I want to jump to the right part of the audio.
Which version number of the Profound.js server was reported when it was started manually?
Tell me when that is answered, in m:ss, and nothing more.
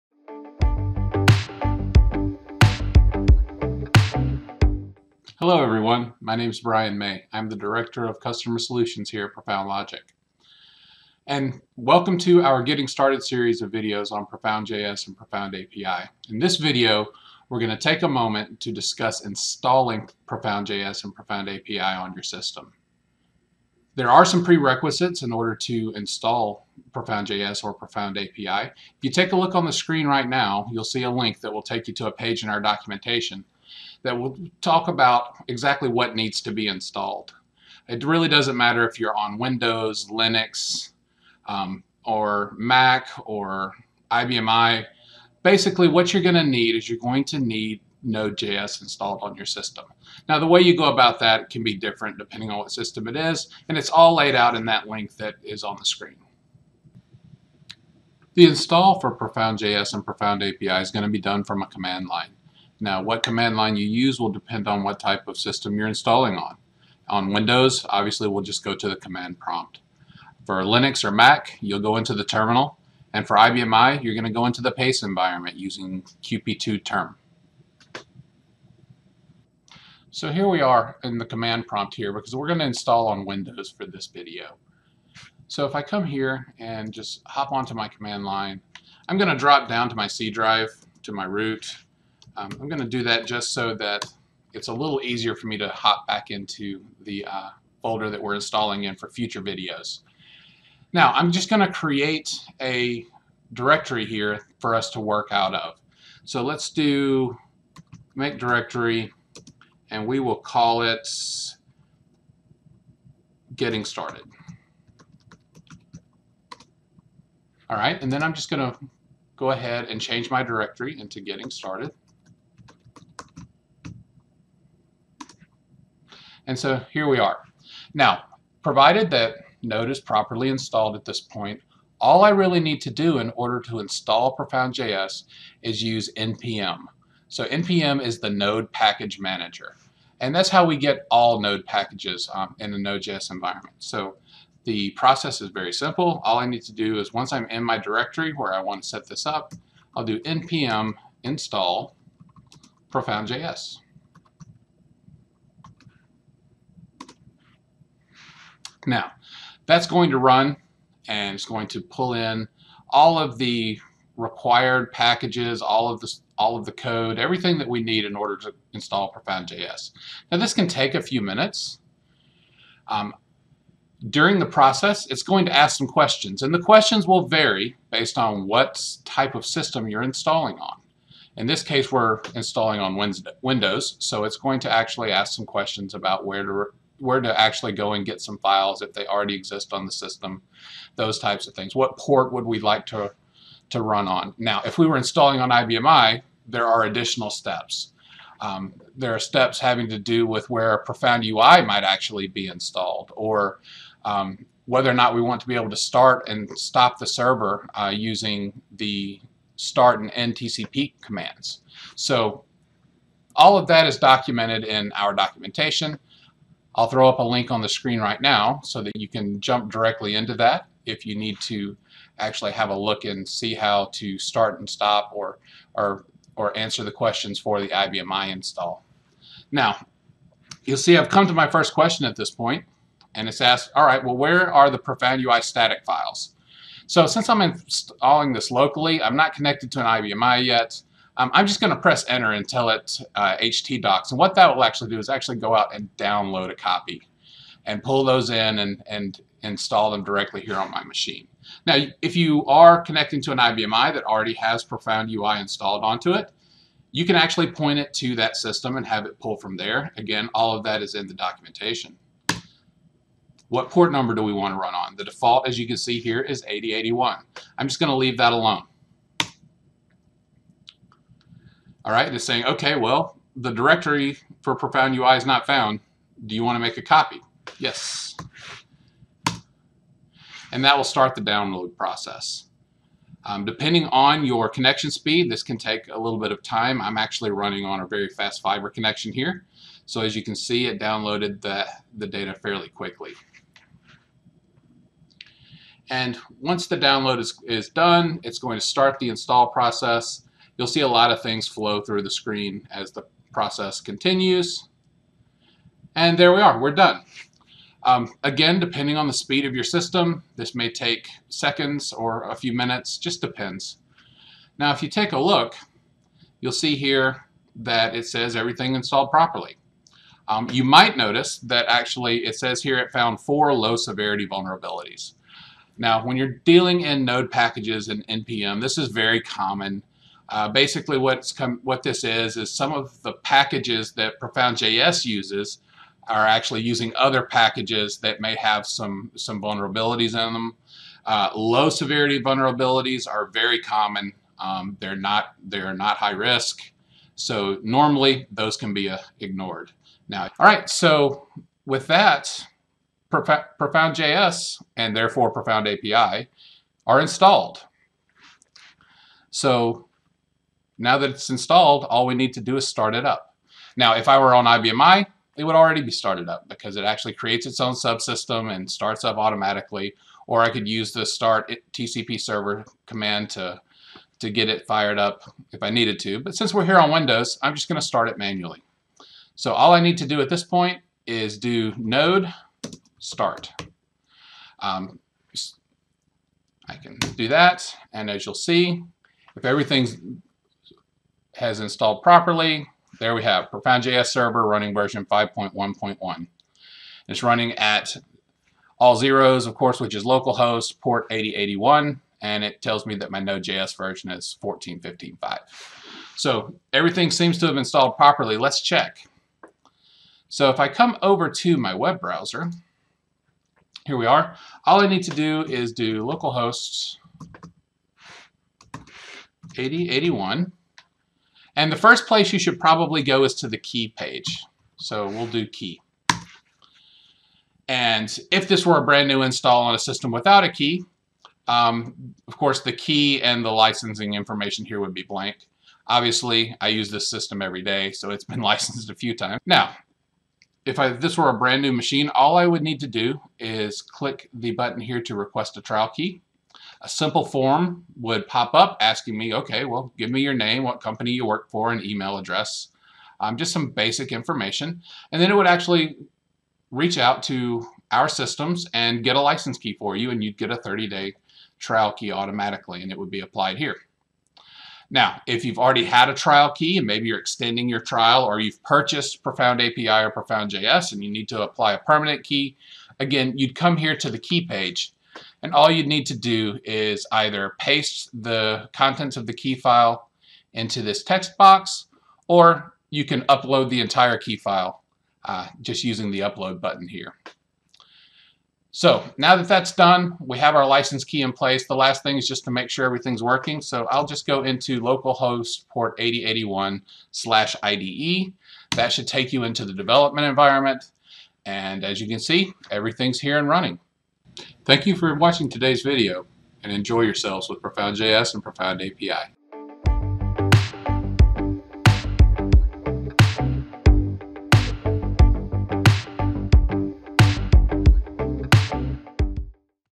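6:35.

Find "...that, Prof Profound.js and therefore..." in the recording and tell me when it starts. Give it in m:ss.
5:51.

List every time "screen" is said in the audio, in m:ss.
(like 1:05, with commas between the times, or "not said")
0:29, 0:55, 3:37, 5:02.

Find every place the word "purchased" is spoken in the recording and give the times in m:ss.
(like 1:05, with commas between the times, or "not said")
7:48.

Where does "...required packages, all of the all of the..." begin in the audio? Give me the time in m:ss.
2:44.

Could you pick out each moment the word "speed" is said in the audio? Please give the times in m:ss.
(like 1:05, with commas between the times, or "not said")
4:44, 5:09.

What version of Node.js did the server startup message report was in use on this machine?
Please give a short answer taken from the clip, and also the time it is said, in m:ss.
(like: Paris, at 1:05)
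14.15.5, at 6:44.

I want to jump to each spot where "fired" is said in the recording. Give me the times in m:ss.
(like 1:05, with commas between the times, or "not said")
6:14.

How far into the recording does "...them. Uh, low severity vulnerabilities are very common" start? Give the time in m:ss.
5:40.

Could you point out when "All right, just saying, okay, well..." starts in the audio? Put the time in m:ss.
4:31.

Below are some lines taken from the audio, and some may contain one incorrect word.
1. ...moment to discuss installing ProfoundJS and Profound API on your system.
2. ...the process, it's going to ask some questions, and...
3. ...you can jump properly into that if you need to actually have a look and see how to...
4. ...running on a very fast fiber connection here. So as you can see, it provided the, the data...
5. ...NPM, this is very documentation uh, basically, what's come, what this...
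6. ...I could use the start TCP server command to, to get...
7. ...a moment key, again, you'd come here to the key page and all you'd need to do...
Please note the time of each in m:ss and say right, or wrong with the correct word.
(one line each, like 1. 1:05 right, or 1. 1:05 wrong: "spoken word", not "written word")
1. 0:18 right
2. 2:54 right
3. 3:38 wrong: "directly", not "properly"
4. 4:47 wrong: "downloaded", not "provided"
5. 5:28 wrong: "common", not "documentation"
6. 6:10 right
7. 7:51 wrong: "permanent", not "moment".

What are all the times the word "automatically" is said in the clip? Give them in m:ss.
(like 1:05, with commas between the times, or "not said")
6:09, 7:42.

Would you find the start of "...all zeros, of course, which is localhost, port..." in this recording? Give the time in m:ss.
6:38.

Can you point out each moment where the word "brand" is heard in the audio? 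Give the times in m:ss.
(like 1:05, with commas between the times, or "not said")
7:08, 7:21.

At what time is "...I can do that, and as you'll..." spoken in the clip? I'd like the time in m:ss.
6:26.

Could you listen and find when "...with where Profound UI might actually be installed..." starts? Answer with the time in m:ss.
3:20.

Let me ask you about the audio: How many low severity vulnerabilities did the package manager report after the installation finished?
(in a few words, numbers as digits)
4.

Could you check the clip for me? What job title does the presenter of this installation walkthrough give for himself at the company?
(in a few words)
Director of Customer Solutions.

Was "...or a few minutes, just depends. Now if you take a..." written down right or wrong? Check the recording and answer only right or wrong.
right.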